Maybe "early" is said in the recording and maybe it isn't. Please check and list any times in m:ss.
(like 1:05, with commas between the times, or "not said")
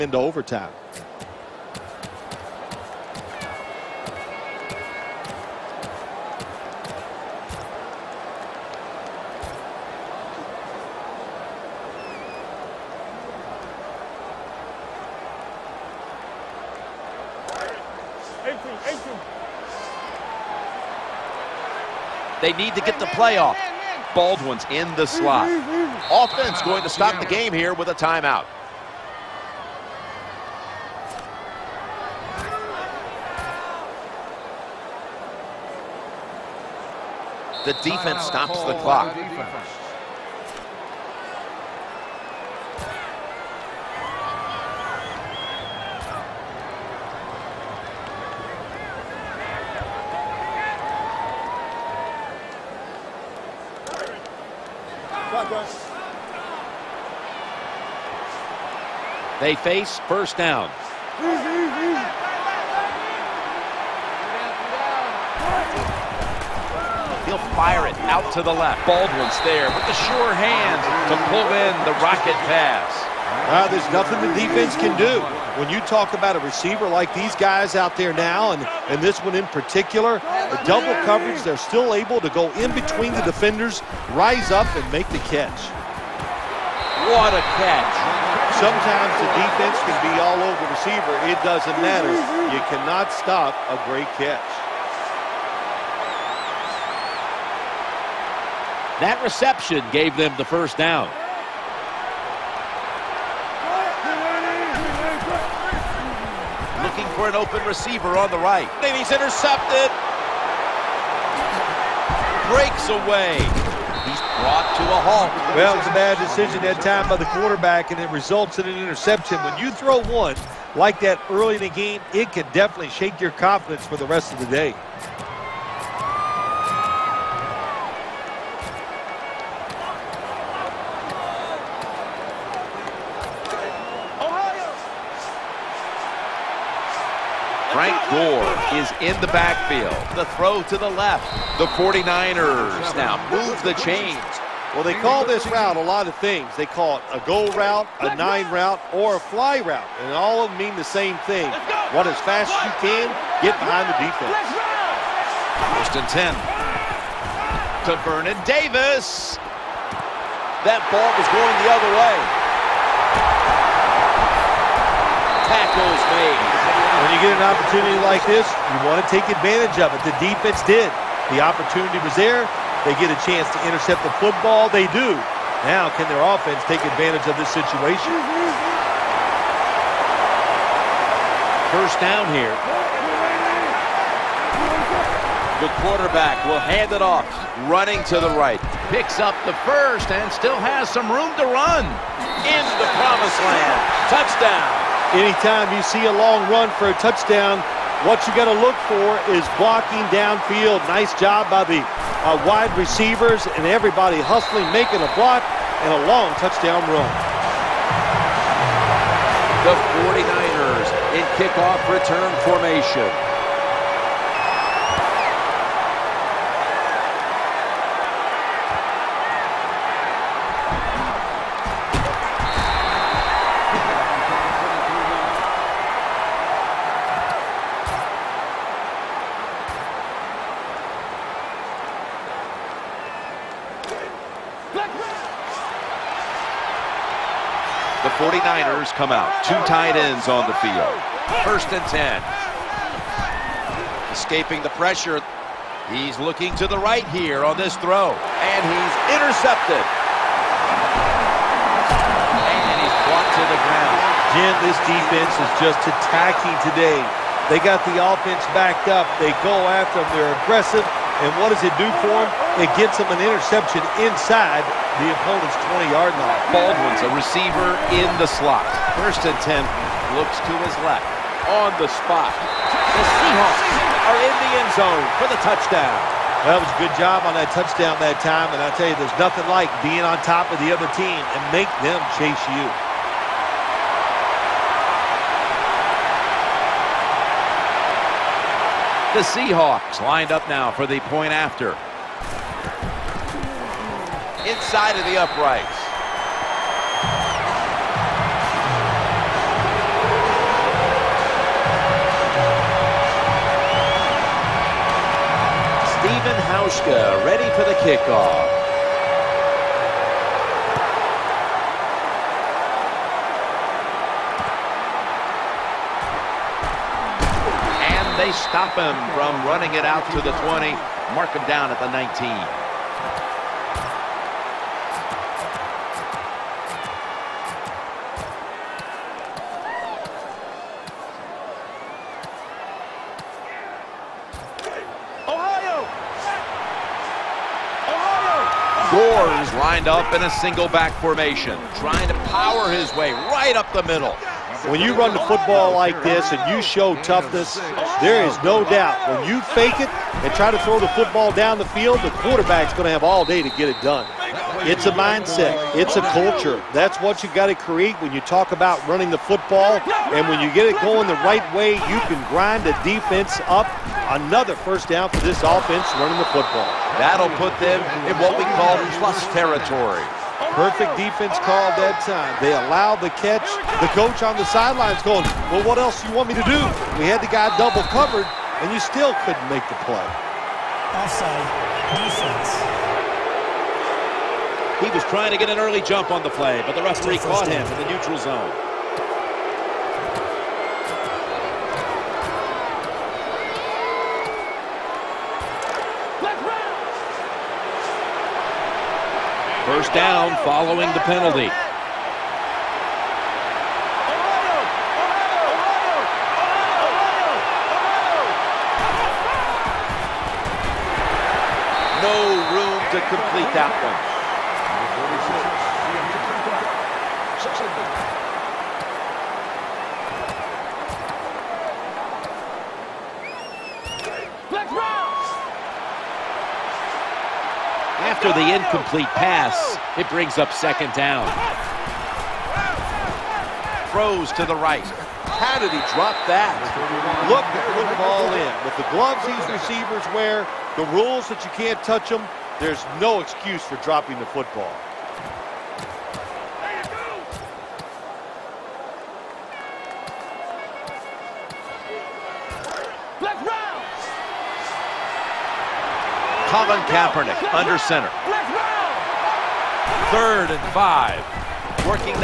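2:01, 6:25.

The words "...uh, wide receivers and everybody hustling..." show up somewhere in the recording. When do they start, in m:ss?
3:22.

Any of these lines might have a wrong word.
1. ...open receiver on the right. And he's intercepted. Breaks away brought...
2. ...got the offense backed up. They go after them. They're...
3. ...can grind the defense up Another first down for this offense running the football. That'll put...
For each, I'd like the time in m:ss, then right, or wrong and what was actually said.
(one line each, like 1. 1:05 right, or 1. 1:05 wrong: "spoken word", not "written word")
1. 1:47 right
2. 4:17 right
3. 6:02 right.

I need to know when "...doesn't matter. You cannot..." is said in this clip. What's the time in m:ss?
1:31.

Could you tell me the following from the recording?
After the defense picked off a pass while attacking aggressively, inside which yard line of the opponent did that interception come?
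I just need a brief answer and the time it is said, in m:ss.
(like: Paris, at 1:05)
20-yard line, at 4:25.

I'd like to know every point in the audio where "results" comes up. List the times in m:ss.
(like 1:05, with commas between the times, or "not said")
1:58.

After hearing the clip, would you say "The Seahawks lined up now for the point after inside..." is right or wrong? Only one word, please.
right.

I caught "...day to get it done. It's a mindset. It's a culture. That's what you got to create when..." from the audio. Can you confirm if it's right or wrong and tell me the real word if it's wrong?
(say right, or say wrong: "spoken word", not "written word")
right.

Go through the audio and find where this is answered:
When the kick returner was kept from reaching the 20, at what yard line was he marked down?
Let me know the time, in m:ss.
5:21.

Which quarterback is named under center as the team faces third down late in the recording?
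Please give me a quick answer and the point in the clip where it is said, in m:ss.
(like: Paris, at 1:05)
Colin Kaepernick, at 7:36.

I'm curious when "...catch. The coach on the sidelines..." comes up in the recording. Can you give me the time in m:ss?
6:13.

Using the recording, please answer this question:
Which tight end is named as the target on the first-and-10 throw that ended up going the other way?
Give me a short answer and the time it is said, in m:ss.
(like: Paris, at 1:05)
Vernon Davis, at 2:38.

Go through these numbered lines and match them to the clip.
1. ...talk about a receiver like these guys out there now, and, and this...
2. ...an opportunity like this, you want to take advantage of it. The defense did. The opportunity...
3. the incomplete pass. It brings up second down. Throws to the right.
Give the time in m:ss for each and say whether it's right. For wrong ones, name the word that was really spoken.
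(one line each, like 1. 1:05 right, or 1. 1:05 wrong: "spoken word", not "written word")
1. 1:15 right
2. 2:47 right
3. 7:08 right.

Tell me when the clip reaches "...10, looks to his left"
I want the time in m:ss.
4:29.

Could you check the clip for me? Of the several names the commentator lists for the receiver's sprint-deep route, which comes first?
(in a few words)
goal route.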